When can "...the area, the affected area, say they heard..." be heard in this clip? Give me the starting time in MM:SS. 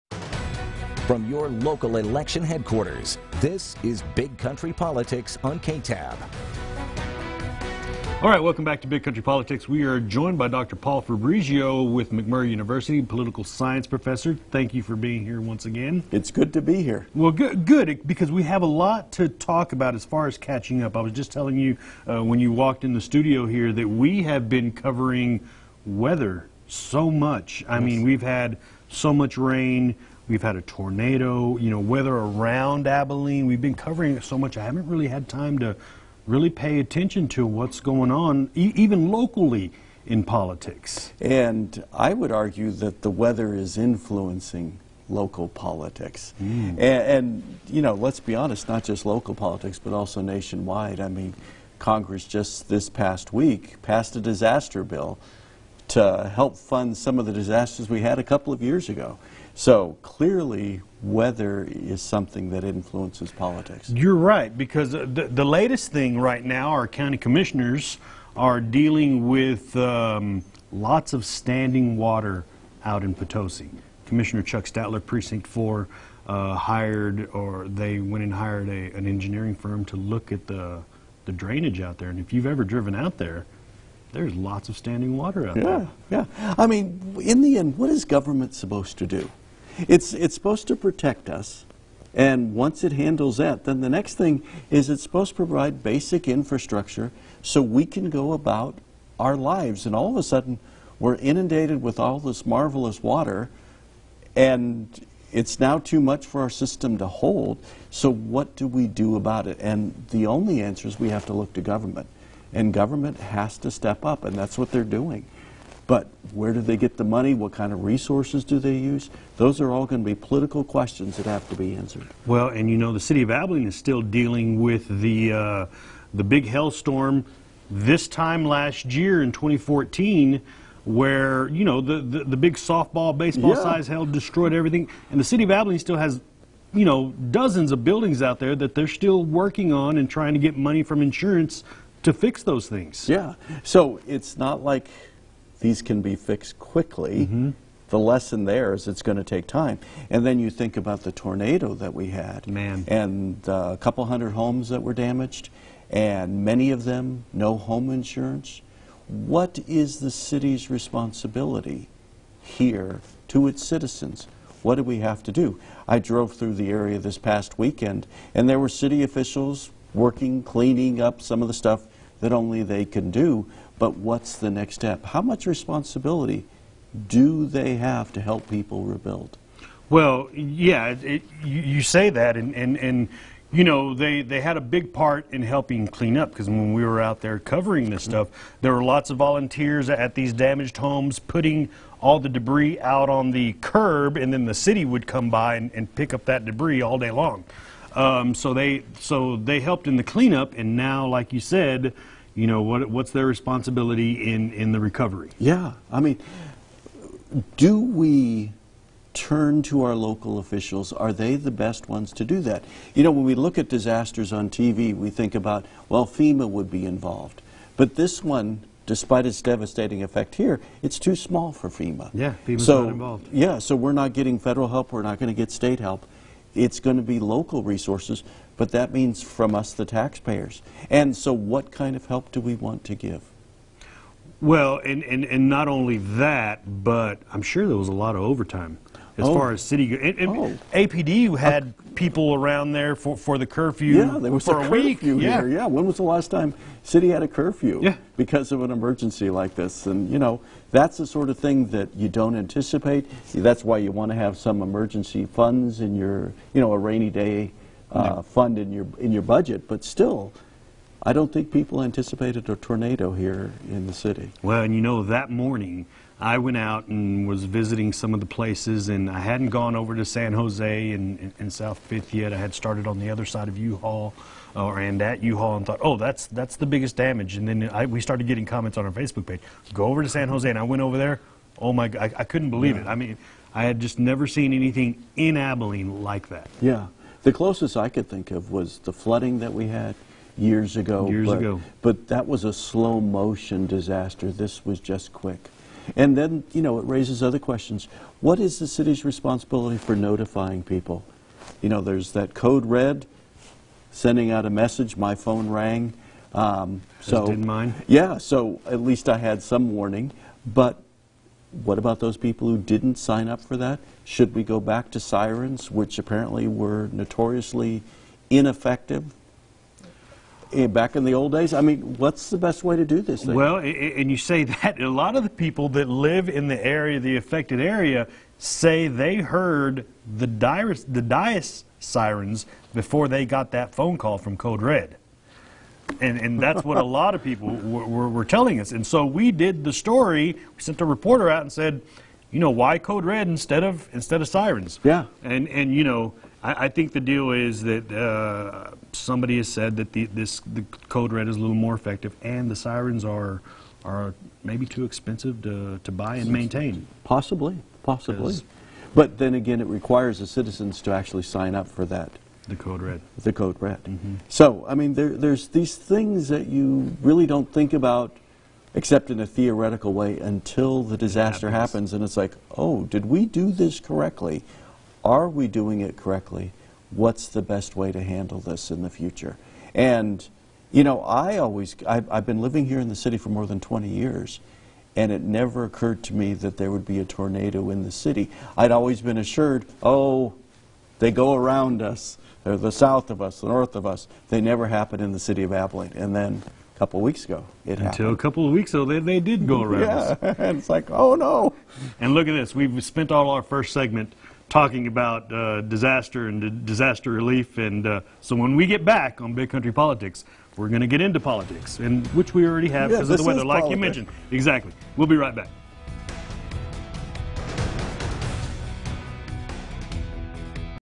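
05:26.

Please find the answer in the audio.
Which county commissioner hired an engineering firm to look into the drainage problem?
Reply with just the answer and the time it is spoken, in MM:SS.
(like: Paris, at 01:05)
Chuck Statler, at 01:14.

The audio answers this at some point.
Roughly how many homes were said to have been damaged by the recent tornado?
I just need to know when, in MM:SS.
02:33.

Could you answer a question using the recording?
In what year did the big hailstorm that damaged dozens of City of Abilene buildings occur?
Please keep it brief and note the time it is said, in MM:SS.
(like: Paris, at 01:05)
2014, at 02:09.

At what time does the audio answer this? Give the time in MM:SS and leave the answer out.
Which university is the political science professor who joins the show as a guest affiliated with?
00:12.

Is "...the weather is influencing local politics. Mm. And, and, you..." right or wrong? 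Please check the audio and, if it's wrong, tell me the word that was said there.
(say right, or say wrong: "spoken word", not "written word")
right.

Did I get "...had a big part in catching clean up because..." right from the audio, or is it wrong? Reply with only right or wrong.
wrong.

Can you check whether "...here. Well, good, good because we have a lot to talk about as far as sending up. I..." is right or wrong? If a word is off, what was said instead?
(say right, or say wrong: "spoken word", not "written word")
wrong: "catching", not "sending".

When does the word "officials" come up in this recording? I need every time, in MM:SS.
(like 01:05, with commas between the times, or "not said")
02:49, 03:30.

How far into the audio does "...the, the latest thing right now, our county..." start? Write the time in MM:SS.
01:04.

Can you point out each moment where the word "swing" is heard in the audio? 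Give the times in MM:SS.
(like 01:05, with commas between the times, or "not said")
not said.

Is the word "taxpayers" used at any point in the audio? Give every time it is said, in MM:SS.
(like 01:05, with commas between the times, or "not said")
03:49.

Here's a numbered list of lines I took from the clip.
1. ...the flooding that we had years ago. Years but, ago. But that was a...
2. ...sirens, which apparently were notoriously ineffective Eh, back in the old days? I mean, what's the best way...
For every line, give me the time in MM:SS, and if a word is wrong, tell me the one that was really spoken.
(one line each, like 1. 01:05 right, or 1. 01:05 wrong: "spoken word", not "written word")
1. 04:48 right
2. 05:14 right.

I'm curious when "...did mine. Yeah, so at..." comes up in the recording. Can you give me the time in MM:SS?
05:07.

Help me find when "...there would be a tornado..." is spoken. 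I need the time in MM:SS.
06:26.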